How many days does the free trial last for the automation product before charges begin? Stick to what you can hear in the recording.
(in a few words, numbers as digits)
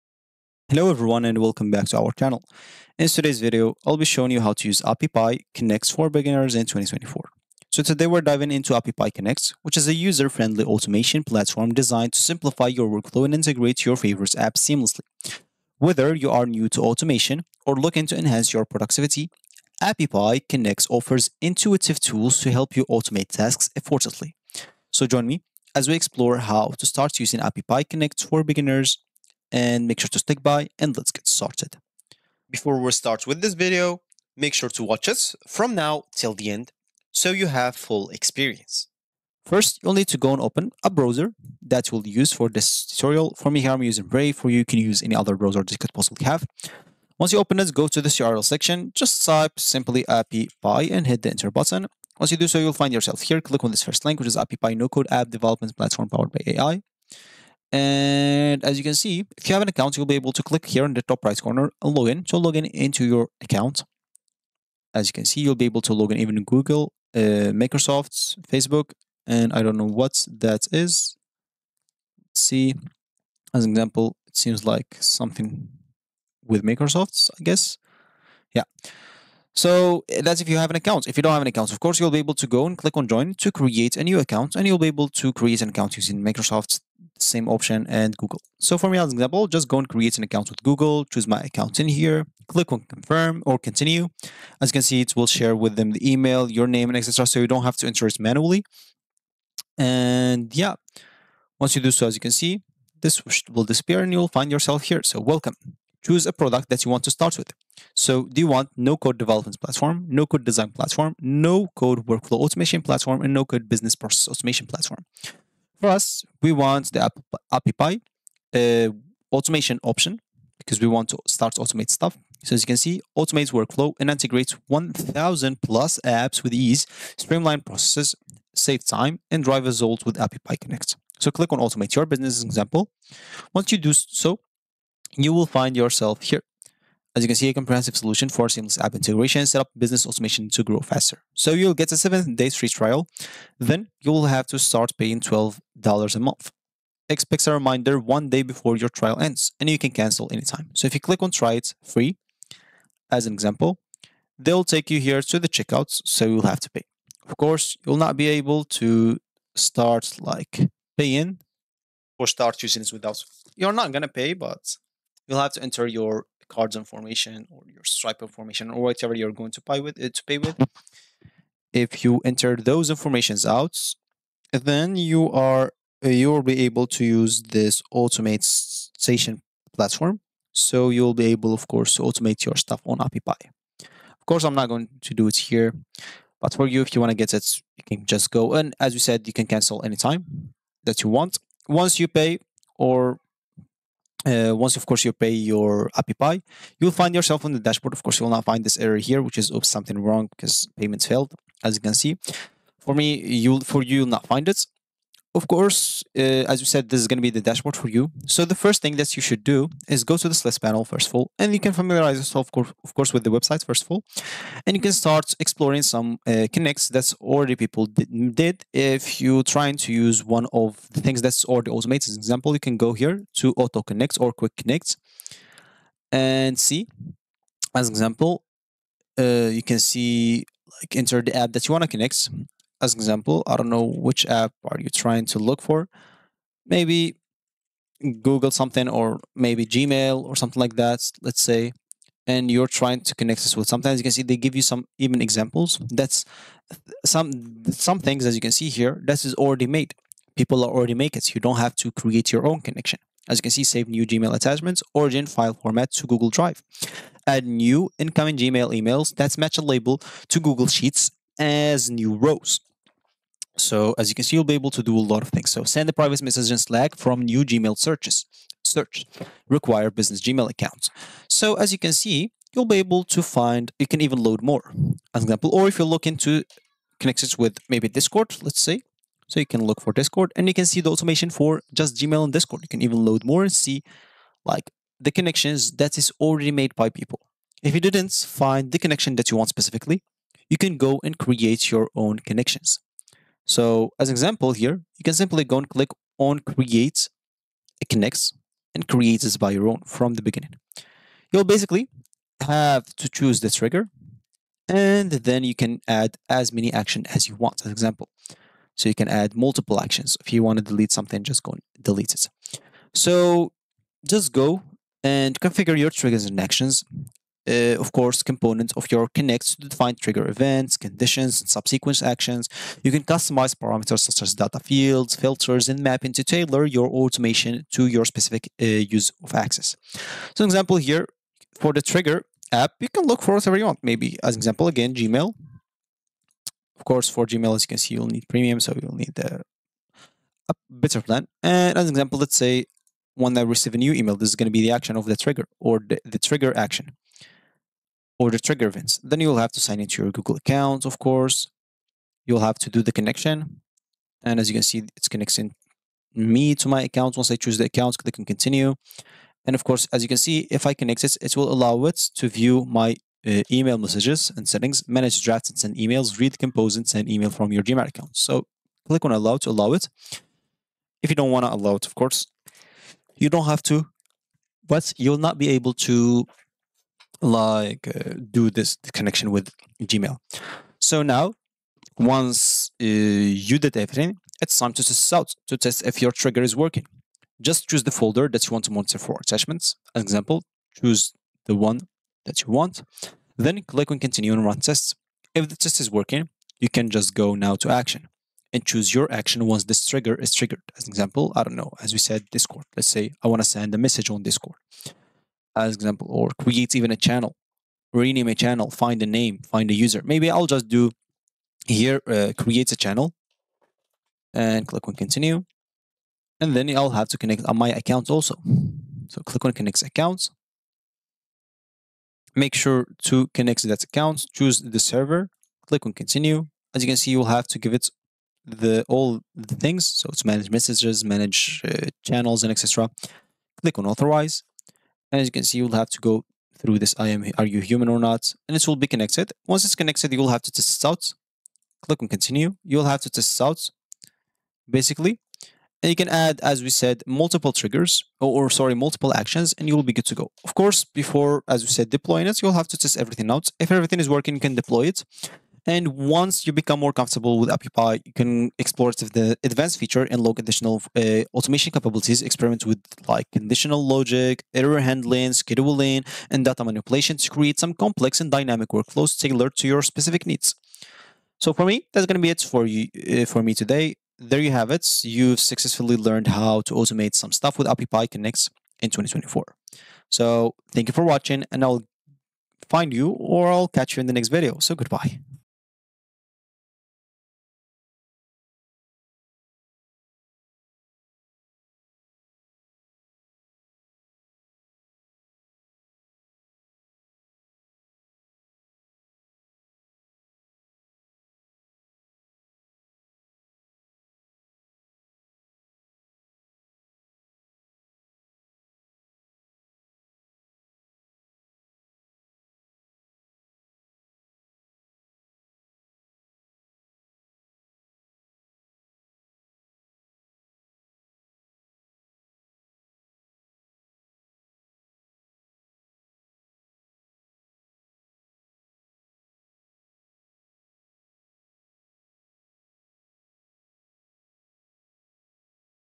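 7.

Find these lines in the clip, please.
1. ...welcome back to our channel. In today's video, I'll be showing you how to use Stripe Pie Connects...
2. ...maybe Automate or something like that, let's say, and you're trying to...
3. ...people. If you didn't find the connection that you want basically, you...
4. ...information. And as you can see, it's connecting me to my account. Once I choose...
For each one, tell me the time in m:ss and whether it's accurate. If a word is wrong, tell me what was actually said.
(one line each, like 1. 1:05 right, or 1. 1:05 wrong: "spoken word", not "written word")
1. 0:01 wrong: "Appy", not "Stripe"
2. 3:59 wrong: "Gmail", not "Automate"
3. 4:46 wrong: "specifically", not "basically"
4. 5:52 wrong: "connection", not "information".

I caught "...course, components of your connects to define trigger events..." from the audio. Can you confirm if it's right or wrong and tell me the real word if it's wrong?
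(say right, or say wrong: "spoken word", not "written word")
right.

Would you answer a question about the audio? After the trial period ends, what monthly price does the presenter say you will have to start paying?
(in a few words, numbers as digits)
$12.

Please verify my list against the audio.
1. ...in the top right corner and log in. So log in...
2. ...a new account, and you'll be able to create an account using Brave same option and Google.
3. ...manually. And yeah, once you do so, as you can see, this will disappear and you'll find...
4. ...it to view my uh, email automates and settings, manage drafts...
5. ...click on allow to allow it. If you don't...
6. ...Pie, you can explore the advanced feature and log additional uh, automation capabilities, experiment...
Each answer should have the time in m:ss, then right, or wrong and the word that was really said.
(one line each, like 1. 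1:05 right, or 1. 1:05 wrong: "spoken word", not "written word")
1. 1:00 right
2. 1:23 wrong: "Microsoft", not "Brave"
3. 1:38 right
4. 6:01 wrong: "messages", not "automates"
5. 6:08 right
6. 7:37 right.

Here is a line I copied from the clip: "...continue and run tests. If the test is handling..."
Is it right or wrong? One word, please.
wrong.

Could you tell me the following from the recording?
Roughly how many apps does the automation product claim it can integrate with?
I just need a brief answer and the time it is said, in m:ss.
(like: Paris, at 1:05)
1,000 plus, at 2:04.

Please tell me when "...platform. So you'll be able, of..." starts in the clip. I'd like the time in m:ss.
2:59.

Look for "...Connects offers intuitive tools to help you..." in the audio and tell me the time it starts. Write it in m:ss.
0:20.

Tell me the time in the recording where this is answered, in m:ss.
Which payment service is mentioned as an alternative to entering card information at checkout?
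2:47.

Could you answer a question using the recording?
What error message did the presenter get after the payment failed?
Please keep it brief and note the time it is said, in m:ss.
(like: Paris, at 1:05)
Oops something wrong, at 3:19.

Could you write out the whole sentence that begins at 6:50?
Maybe I'll just do here, uh, creates a channel and click on continue.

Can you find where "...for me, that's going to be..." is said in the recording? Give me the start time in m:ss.
7:51.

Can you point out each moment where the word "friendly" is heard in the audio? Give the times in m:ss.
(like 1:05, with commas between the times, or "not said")
0:09.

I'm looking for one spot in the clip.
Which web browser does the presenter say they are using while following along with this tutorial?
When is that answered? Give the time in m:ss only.
0:44.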